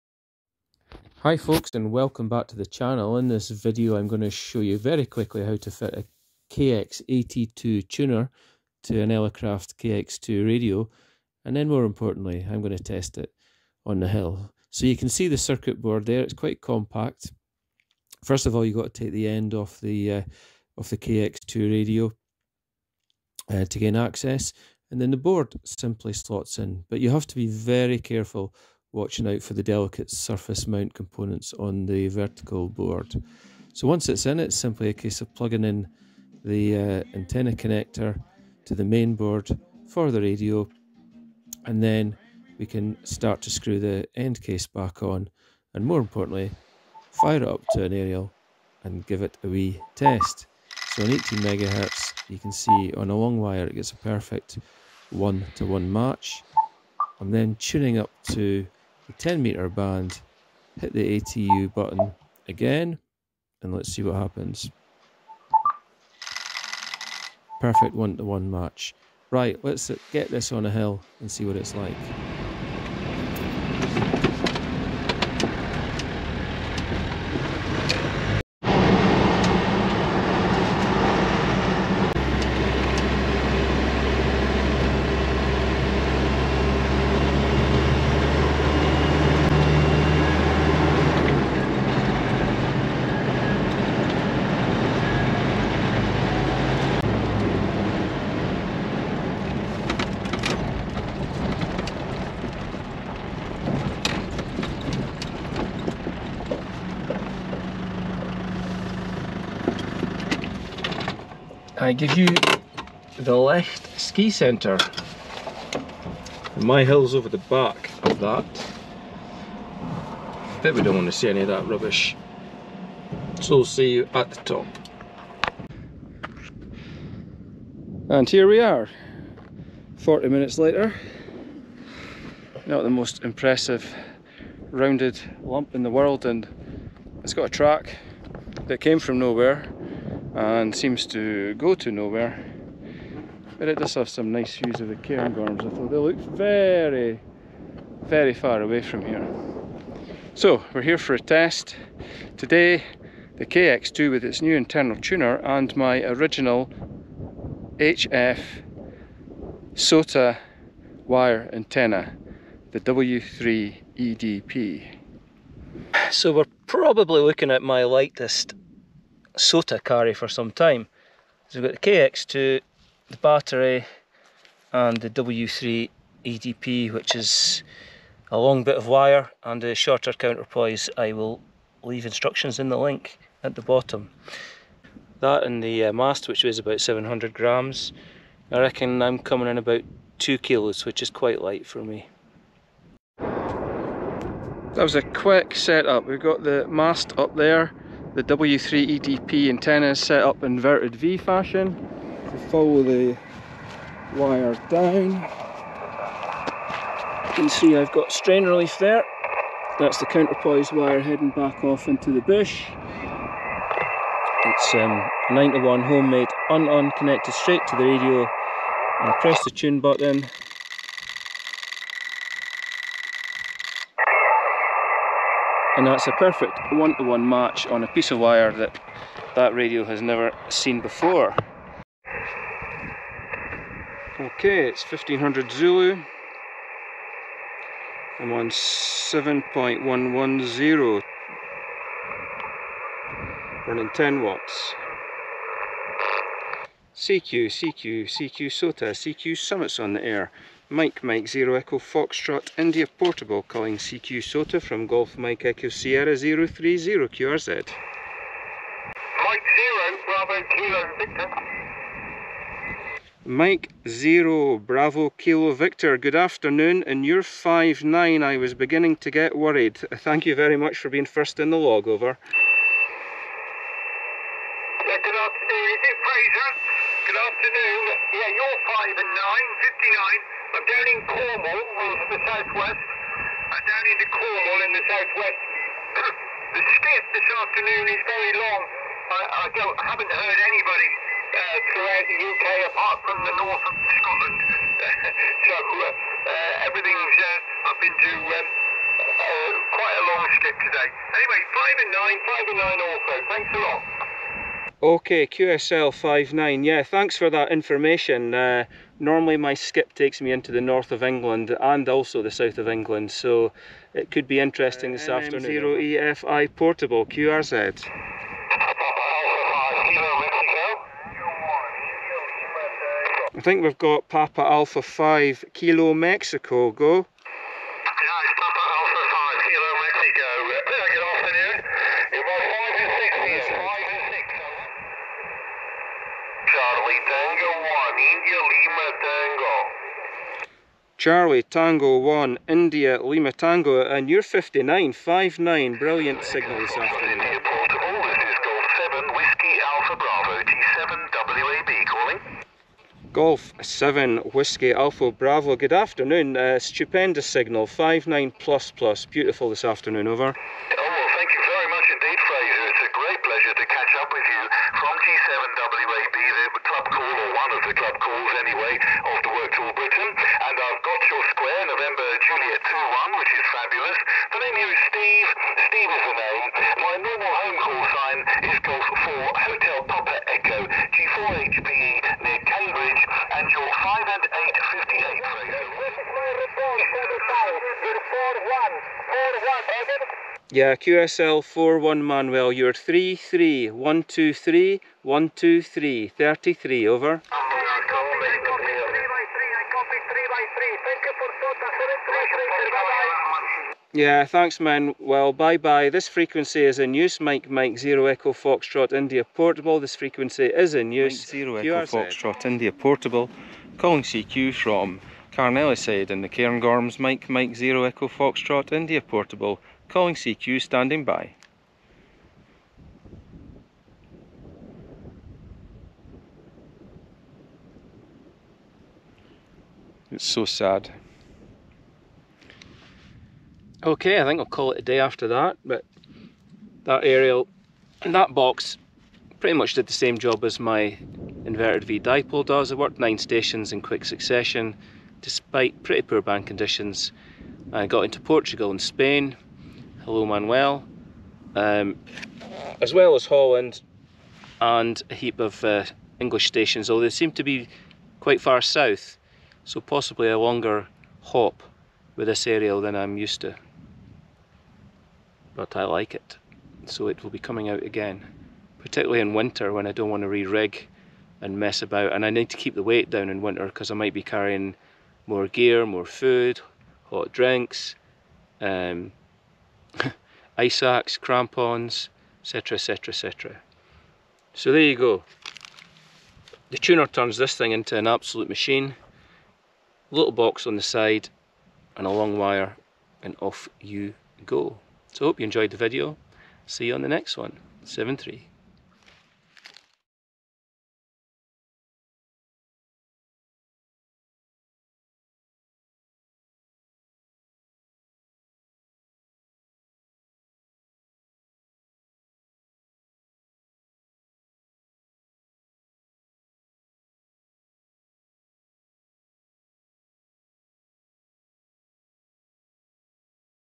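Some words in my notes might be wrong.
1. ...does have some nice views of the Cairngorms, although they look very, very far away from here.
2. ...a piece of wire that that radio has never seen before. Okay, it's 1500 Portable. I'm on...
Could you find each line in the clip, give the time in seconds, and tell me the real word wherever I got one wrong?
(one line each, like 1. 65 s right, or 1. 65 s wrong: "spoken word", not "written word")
1. 143 s right
2. 227 s wrong: "Zulu", not "Portable".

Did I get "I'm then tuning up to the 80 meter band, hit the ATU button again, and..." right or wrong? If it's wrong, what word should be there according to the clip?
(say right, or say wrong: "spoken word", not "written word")
wrong: "10", not "80".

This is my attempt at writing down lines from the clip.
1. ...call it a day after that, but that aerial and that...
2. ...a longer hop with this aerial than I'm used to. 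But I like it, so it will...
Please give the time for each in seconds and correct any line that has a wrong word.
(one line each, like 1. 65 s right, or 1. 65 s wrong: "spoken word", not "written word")
1. 434 s right
2. 460 s right.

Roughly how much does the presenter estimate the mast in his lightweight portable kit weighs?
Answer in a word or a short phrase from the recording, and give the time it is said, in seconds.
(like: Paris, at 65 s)
700 grams, at 186 s.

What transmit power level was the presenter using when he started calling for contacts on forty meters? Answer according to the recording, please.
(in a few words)
10 watts.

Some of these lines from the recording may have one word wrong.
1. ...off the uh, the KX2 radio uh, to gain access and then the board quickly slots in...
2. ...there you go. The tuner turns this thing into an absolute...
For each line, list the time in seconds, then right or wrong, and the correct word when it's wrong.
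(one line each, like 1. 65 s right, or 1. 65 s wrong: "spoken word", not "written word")
1. 19 s wrong: "simply", not "quickly"
2. 484 s right.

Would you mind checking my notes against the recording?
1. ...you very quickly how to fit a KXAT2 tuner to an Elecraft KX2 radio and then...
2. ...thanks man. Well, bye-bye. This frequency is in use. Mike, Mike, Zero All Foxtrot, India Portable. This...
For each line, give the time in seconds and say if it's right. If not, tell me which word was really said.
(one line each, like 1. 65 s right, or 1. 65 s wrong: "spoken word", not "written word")
1. 4 s right
2. 404 s wrong: "Echo", not "All".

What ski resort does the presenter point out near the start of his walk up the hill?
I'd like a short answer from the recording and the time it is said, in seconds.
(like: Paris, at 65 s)
Lecht ski centre, at 113 s.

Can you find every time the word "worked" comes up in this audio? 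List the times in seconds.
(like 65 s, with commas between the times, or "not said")
369 s, 442 s.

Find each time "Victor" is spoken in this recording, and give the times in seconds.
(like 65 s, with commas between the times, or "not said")
260 s, 265 s.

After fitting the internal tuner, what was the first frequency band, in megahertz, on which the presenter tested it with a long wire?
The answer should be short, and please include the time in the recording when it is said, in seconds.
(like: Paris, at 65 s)
18, at 51 s.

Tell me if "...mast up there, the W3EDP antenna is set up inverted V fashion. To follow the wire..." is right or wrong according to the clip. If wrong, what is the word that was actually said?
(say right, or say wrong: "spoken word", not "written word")
right.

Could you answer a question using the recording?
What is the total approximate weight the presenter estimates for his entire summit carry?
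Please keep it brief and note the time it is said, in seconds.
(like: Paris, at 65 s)
2 kilos, at 190 s.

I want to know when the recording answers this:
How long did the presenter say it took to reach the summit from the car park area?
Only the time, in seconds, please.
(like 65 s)
129 s.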